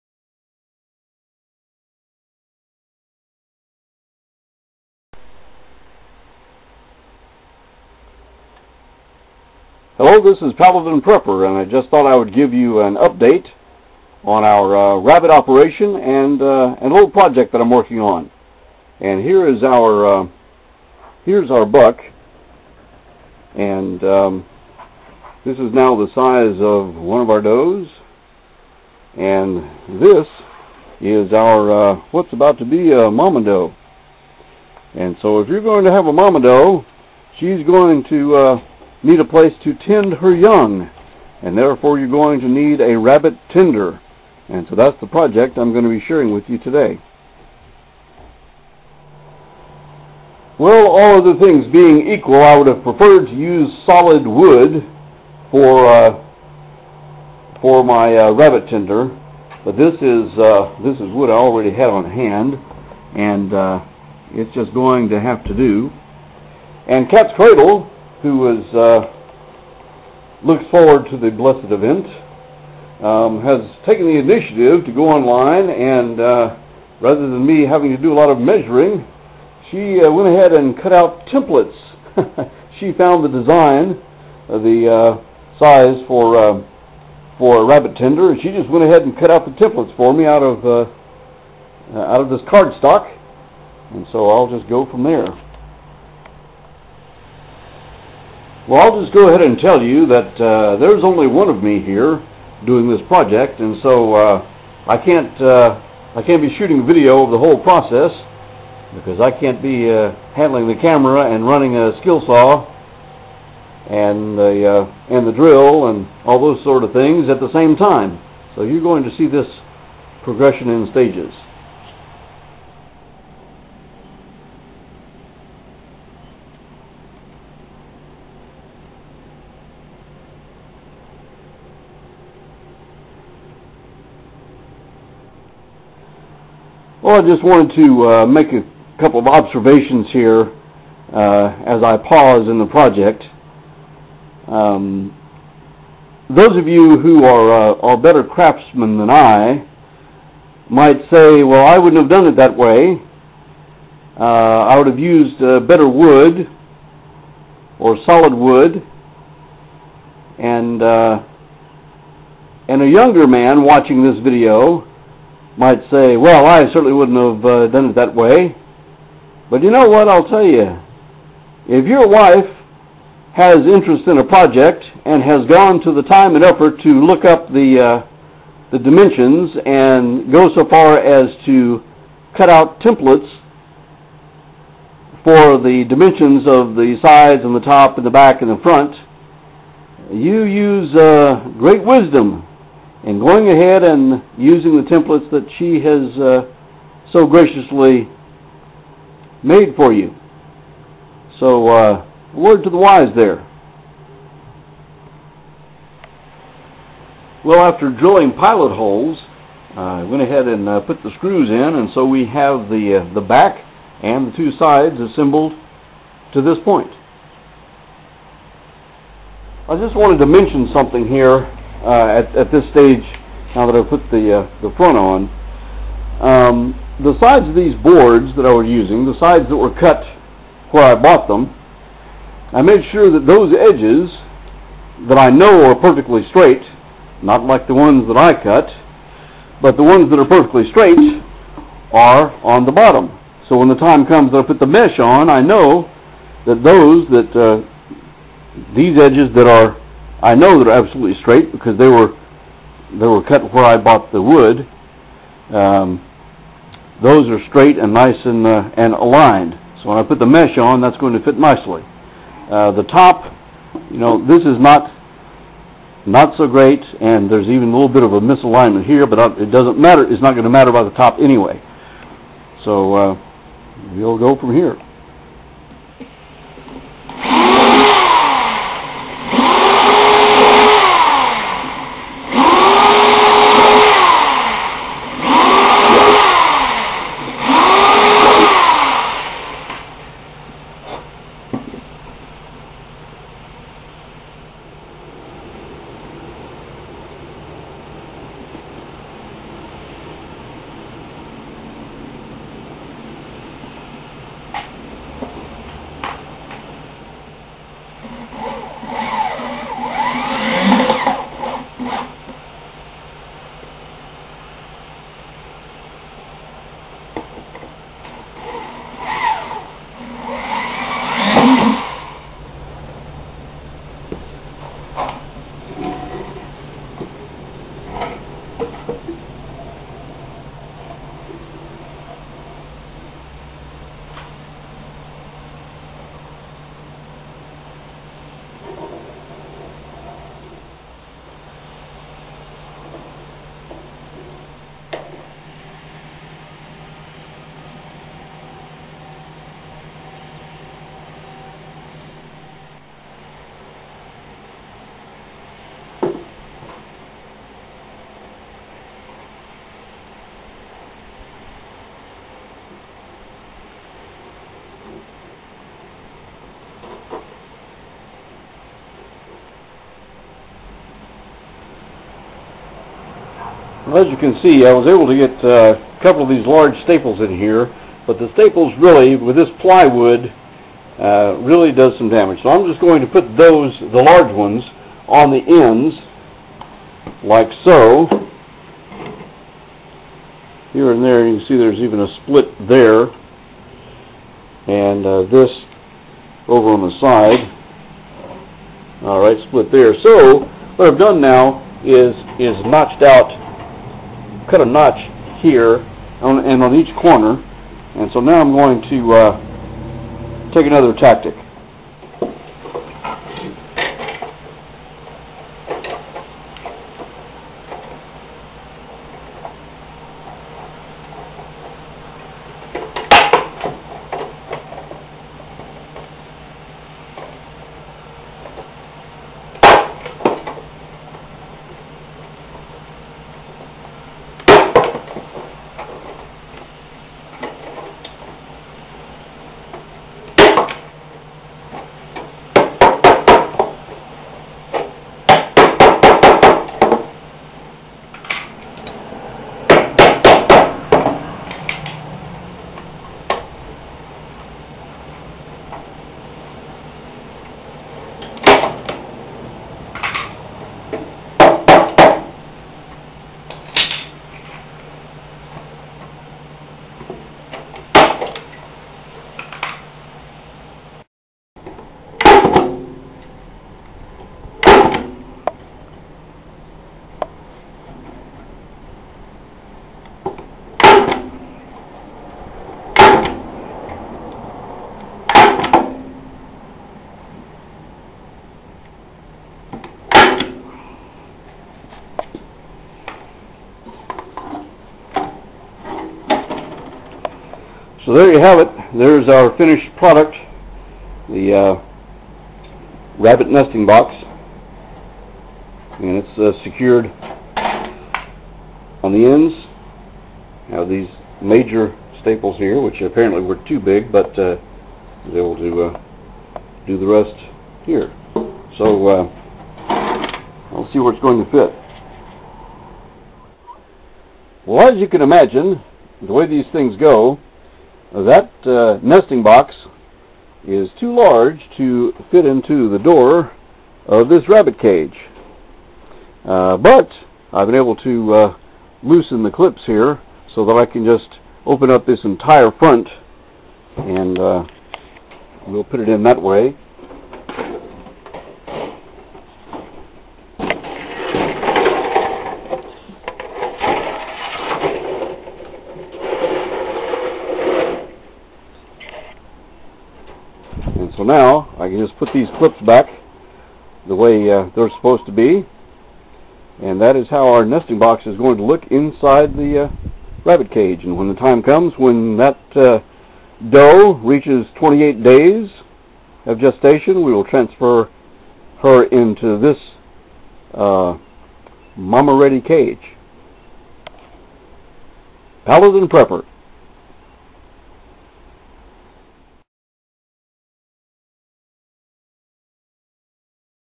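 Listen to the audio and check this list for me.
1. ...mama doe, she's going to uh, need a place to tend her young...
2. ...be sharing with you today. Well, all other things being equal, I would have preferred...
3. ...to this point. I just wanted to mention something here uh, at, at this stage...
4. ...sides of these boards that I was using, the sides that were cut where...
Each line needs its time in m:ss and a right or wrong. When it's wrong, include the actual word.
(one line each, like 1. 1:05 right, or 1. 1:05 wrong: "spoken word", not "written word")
1. 0:36 right
2. 0:45 right
3. 3:36 right
4. 3:47 right.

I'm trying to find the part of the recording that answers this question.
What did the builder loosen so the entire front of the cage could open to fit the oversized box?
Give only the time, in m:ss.
8:59.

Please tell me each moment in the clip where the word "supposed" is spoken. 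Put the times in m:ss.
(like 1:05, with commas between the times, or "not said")
9:24.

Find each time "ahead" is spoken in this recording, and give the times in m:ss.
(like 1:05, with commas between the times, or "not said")
1:20, 1:28, 1:39, 3:13, 3:30.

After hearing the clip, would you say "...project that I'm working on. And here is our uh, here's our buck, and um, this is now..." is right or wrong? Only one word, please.
right.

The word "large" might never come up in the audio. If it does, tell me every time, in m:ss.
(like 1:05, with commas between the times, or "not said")
6:16, 6:24, 8:51.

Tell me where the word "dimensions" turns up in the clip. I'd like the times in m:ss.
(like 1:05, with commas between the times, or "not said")
2:58, 3:05.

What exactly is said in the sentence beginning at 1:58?
So you're going to see this progression in stages.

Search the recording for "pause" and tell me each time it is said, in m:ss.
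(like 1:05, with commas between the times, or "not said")
2:21.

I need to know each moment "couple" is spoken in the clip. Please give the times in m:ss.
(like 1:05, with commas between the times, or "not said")
2:18, 6:16.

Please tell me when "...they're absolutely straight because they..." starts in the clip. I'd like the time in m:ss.
4:10.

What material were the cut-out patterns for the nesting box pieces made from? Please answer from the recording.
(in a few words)
cardstock.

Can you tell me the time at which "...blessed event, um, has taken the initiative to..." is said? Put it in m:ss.
1:11.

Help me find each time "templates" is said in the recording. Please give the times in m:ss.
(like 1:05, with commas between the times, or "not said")
1:21, 1:29, 3:02, 3:14.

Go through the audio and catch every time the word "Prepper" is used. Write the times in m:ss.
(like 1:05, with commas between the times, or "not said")
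0:10, 9:46.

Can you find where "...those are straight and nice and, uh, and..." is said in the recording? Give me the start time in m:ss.
4:16.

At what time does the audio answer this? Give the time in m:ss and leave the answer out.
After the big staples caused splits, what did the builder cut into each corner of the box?
6:44.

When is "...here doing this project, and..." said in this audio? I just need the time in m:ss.
1:41.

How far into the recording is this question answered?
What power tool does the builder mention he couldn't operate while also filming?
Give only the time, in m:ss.
1:51.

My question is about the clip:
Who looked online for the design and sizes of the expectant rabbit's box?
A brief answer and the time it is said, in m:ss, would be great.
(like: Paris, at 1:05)
Cat's Cradle, at 1:07.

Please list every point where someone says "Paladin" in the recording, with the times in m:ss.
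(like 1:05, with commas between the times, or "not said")
0:10, 9:45.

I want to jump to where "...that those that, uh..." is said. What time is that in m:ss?
4:06.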